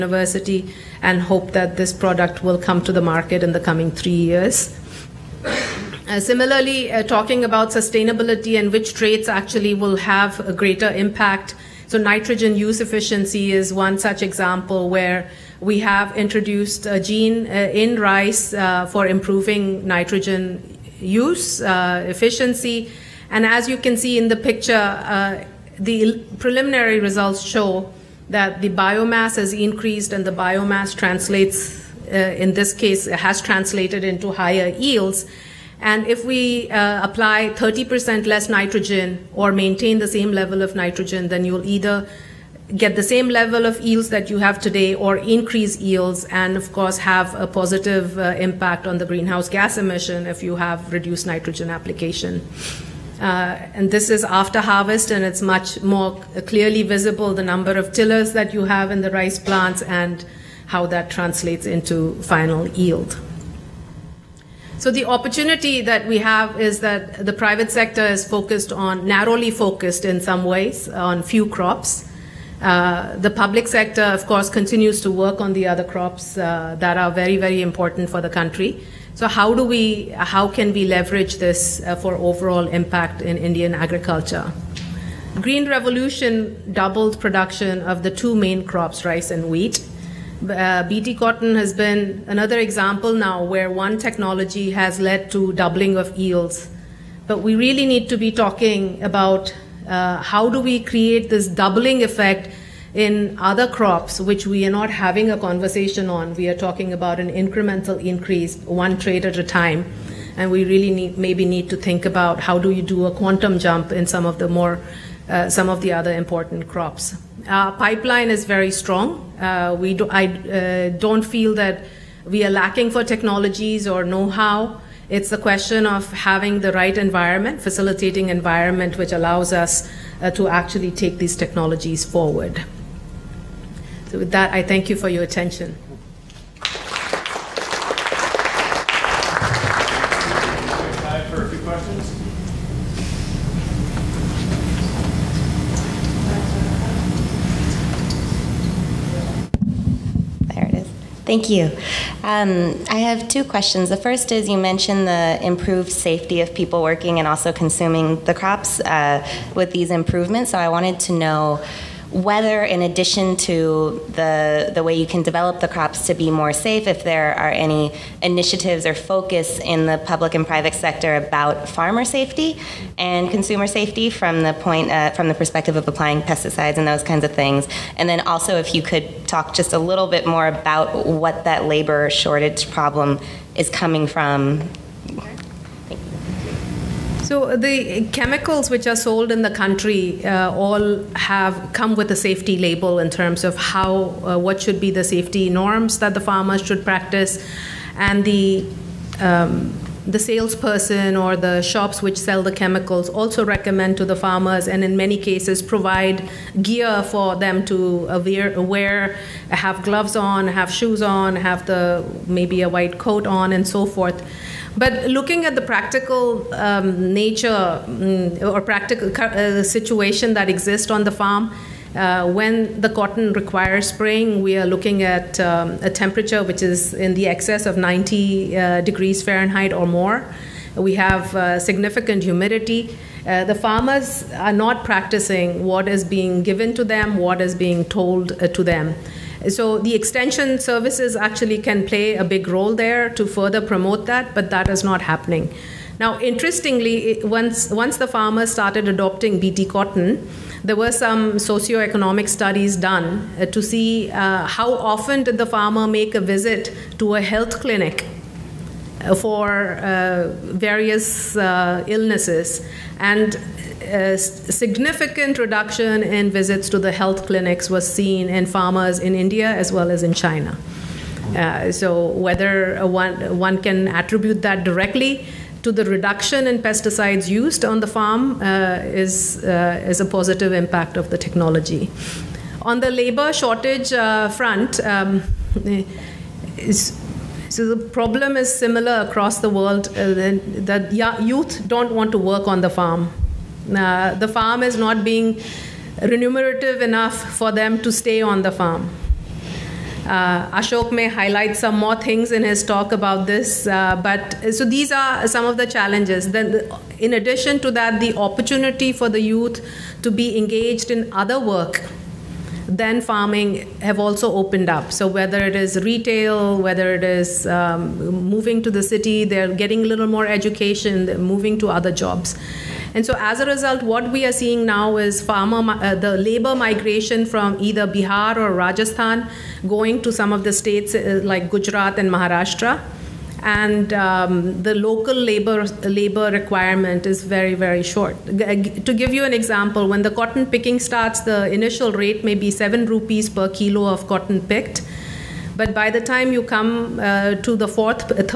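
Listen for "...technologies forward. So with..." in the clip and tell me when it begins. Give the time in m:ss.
2:11.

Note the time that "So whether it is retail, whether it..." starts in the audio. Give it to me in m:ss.
5:14.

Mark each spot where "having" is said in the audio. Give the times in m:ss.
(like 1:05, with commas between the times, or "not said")
1:44, 2:06.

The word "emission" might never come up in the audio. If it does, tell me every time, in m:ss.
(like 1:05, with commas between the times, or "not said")
0:49.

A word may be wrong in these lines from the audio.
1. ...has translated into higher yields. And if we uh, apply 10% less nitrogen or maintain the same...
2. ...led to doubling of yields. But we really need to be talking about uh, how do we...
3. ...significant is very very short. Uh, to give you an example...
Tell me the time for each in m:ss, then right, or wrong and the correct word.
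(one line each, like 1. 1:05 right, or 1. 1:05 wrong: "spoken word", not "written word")
1. 0:33 wrong: "30", not "10"
2. 1:34 right
3. 5:36 wrong: "requirement", not "significant".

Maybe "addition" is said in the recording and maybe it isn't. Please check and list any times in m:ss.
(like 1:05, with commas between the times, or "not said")
2:42, 5:07.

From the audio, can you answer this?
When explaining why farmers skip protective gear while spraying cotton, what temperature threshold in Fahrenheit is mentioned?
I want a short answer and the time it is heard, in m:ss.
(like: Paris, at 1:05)
90 degrees Fahrenheit, at 3:47.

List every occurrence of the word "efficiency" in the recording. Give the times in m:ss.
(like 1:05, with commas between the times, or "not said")
0:12, 0:22.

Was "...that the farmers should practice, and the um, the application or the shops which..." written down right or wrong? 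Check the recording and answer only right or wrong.
wrong.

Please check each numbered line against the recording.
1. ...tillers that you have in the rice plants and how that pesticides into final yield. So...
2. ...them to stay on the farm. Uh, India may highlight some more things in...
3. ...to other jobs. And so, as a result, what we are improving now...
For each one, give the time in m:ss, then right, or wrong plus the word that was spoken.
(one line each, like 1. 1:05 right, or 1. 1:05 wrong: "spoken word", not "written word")
1. 0:57 wrong: "translates", not "pesticides"
2. 4:57 wrong: "Ashok", not "India"
3. 5:21 wrong: "seeing", not "improving".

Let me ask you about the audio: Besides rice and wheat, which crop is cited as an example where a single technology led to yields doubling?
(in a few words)
BT cotton.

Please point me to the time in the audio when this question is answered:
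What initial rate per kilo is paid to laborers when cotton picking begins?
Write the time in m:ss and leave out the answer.
5:42.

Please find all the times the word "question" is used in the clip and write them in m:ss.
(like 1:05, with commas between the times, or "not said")
2:05, 2:33.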